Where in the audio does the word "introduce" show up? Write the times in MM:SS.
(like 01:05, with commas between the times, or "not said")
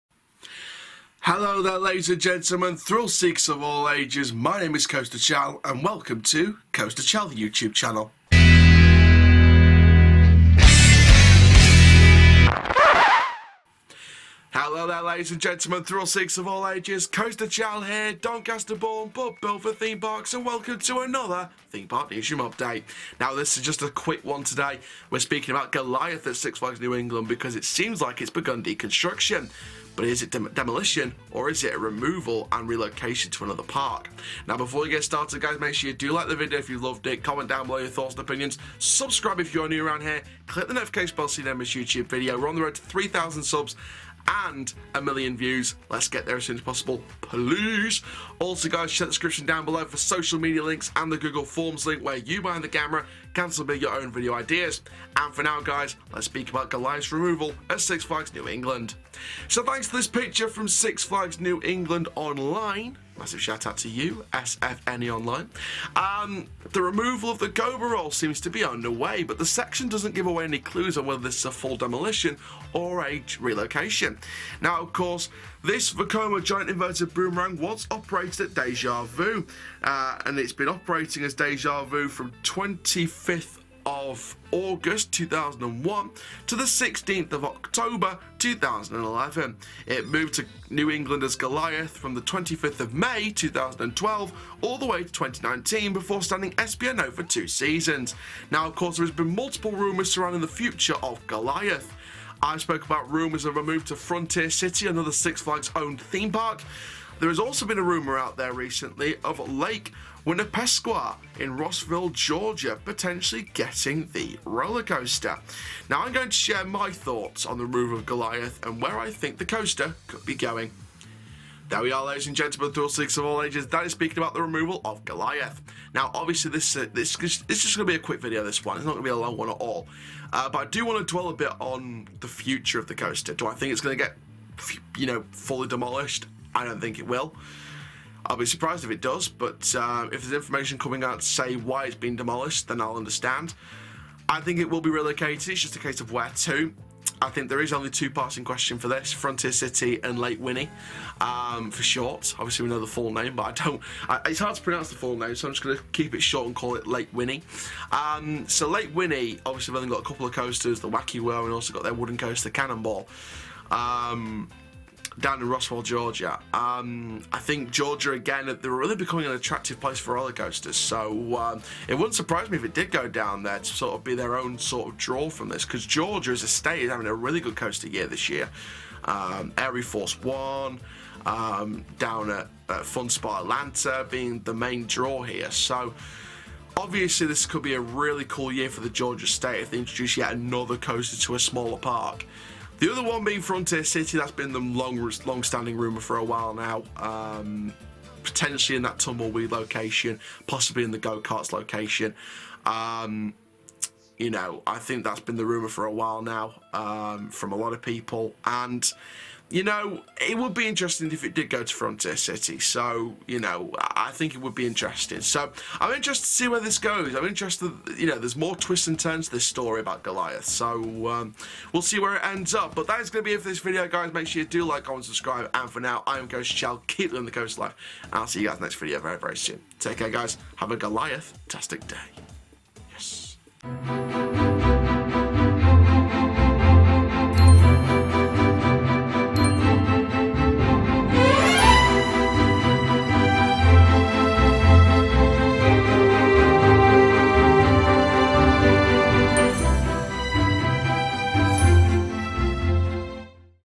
03:09.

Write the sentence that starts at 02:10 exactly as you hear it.
Uh, but I do want to dwell a bit on the future of the coaster.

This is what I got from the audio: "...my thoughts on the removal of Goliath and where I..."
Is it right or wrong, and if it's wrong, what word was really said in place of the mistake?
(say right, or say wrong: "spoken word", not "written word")
right.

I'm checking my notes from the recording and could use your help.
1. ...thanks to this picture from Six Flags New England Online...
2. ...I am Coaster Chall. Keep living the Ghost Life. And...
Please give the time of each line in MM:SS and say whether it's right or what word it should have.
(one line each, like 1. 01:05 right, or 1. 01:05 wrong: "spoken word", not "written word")
1. 00:59 right
2. 03:46 right.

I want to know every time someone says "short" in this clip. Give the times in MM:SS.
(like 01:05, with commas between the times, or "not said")
02:31, 02:36.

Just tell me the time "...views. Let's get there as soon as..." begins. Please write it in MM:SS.
00:45.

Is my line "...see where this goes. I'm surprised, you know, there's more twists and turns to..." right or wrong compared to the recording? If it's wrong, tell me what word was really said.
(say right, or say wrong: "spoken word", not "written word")
wrong: "interested", not "surprised".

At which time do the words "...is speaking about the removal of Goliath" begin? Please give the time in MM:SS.
02:03.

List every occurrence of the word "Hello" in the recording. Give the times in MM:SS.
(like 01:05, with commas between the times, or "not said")
00:01, 00:14.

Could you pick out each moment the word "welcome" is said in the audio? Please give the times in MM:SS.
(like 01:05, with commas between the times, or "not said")
00:05, 00:20.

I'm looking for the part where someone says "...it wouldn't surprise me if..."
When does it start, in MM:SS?
02:51.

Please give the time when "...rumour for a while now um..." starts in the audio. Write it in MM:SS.
03:25.